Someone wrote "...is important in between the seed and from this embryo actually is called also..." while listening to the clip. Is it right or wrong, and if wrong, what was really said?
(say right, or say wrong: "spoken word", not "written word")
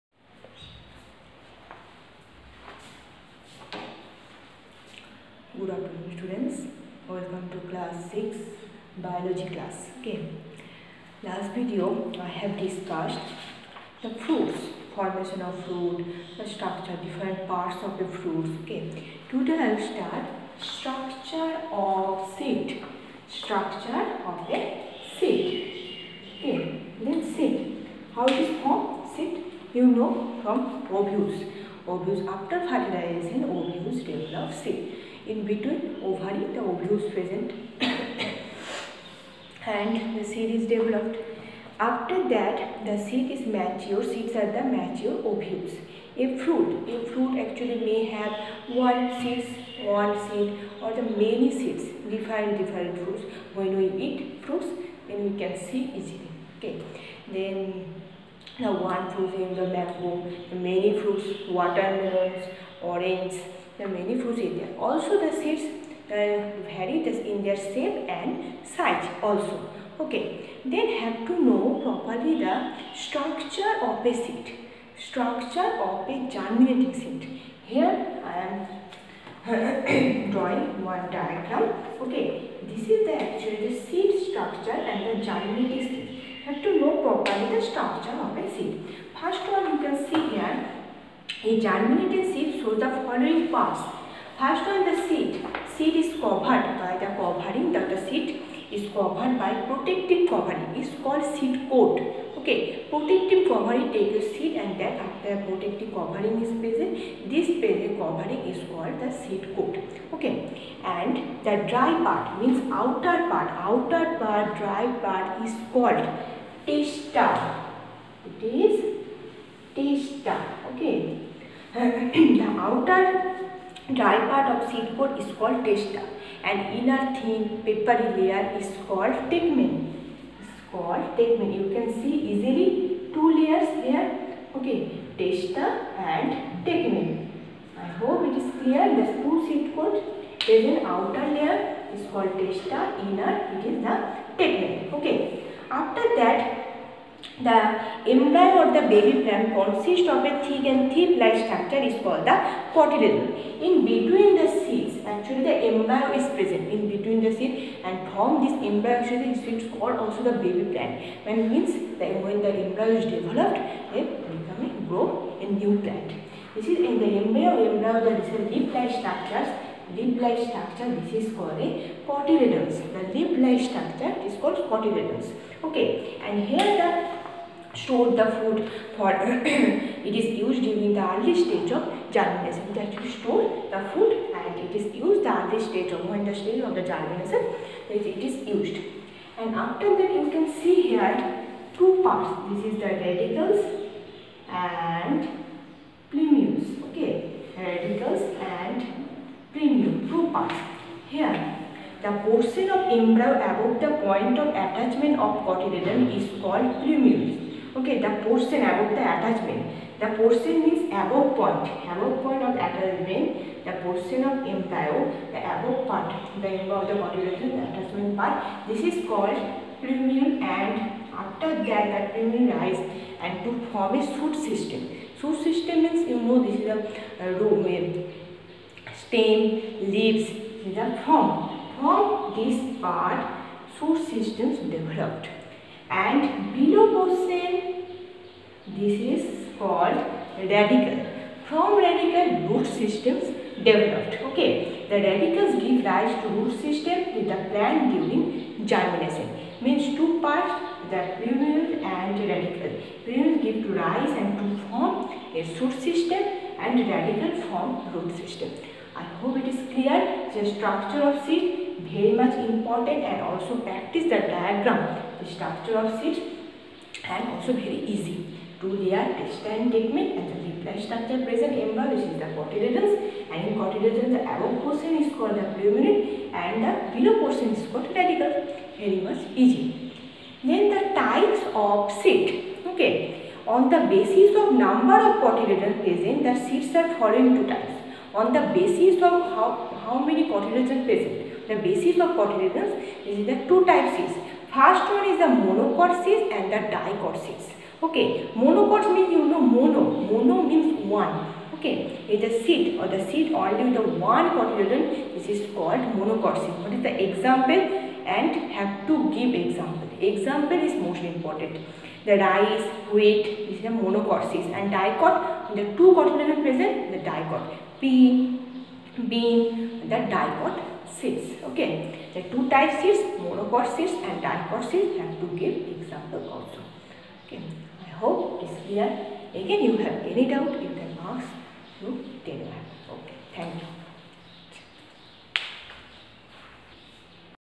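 wrong: "present", not "important".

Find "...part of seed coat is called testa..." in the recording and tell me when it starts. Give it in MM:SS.
02:04.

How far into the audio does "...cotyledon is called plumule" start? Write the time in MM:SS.
03:25.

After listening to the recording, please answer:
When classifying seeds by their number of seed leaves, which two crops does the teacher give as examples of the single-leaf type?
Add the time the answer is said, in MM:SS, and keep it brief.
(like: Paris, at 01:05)
rice, wheat, at 05:12.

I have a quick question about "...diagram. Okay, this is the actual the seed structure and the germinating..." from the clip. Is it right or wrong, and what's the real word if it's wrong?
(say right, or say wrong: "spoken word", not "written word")
right.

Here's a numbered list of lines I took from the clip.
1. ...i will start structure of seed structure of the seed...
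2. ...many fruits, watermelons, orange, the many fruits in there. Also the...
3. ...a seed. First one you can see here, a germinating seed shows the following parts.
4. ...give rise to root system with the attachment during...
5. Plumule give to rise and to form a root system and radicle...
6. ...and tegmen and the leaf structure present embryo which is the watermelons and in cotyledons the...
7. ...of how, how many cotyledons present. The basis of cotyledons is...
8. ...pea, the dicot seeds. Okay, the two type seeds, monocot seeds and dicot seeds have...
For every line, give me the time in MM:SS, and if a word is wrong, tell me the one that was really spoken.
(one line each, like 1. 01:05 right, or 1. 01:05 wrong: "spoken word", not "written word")
1. 00:19 right
2. 01:00 right
3. 01:28 right
4. 04:05 wrong: "plant", not "attachment"
5. 04:13 right
6. 04:28 wrong: "cotyledons", not "watermelons"
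7. 04:49 right
8. 05:17 right.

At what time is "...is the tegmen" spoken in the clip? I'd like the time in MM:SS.
02:23.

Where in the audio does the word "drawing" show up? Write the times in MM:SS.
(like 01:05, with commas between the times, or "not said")
01:20.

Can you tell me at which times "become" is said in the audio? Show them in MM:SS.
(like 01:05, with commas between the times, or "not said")
02:44.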